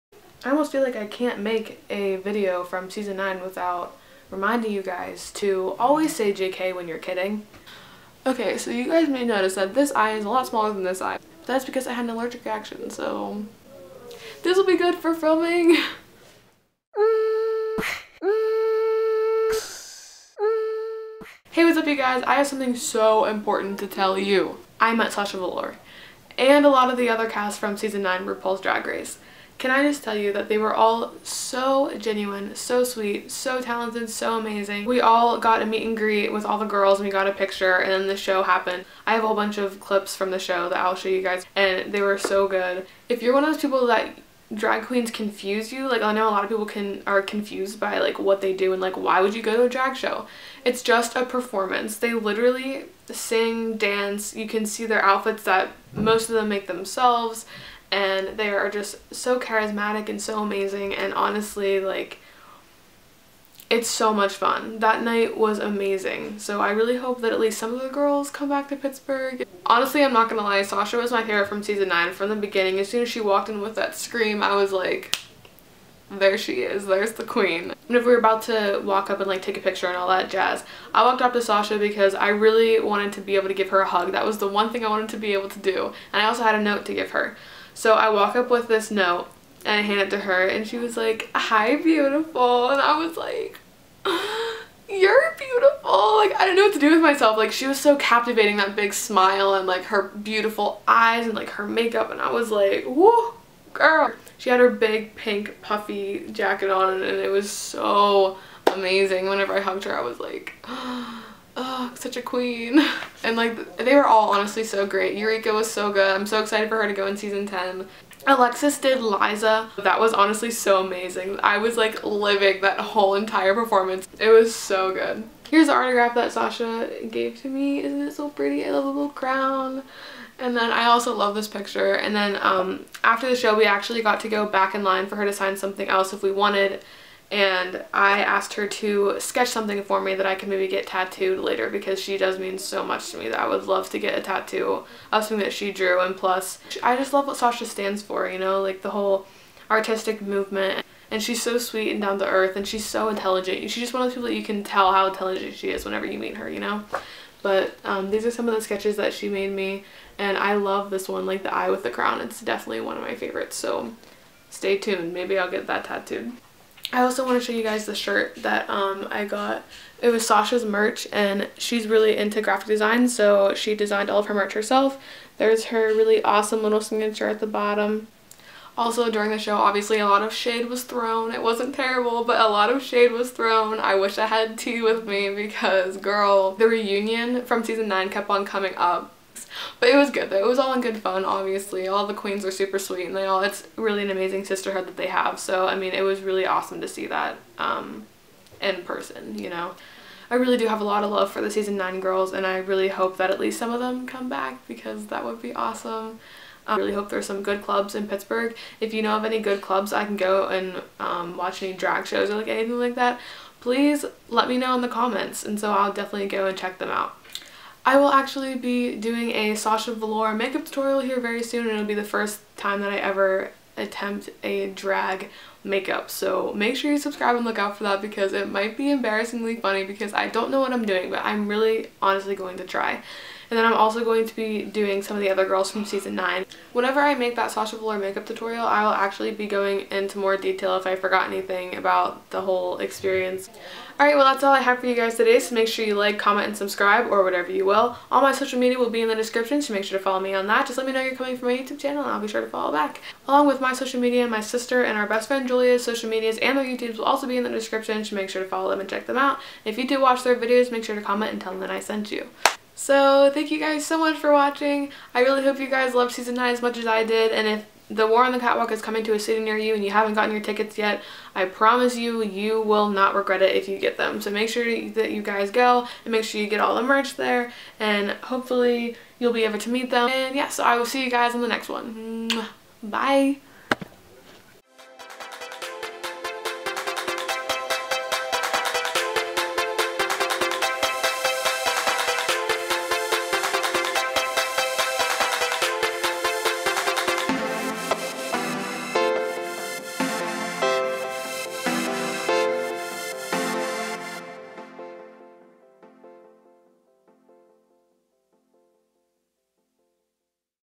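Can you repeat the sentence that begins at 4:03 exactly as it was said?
Alright, well that's all I have for you guys today, so make sure you like, comment, and subscribe, or whatever you will.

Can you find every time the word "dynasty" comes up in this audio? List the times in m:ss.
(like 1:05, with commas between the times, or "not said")
not said.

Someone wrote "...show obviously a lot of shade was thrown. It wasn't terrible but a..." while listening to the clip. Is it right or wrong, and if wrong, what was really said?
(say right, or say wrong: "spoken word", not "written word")
right.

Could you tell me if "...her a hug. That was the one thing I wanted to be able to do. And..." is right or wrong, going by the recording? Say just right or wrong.
right.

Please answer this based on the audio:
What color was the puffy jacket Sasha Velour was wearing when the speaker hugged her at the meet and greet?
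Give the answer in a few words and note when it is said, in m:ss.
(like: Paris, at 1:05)
Pink, at 1:45.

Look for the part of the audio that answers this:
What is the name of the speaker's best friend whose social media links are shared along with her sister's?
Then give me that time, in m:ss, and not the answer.
4:15.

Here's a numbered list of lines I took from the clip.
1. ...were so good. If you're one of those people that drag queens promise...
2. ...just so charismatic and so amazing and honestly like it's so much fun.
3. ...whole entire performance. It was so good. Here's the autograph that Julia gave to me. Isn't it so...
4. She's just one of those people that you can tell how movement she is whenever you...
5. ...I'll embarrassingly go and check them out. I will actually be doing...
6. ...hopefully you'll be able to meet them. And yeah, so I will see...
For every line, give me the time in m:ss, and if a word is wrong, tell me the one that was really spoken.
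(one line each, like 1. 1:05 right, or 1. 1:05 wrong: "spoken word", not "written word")
1. 0:42 wrong: "confuse", not "promise"
2. 0:58 right
3. 2:02 wrong: "Sasha", not "Julia"
4. 2:33 wrong: "intelligent", not "movement"
5. 3:35 wrong: "definitely", not "embarrassingly"
6. 4:38 right.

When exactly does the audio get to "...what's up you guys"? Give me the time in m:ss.
0:21.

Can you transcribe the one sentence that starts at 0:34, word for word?
We all got a meet and greet with all the girls and we got a picture and then the show happened.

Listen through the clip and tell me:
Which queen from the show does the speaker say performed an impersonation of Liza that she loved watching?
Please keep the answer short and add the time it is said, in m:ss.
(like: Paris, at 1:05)
Alexis, at 1:58.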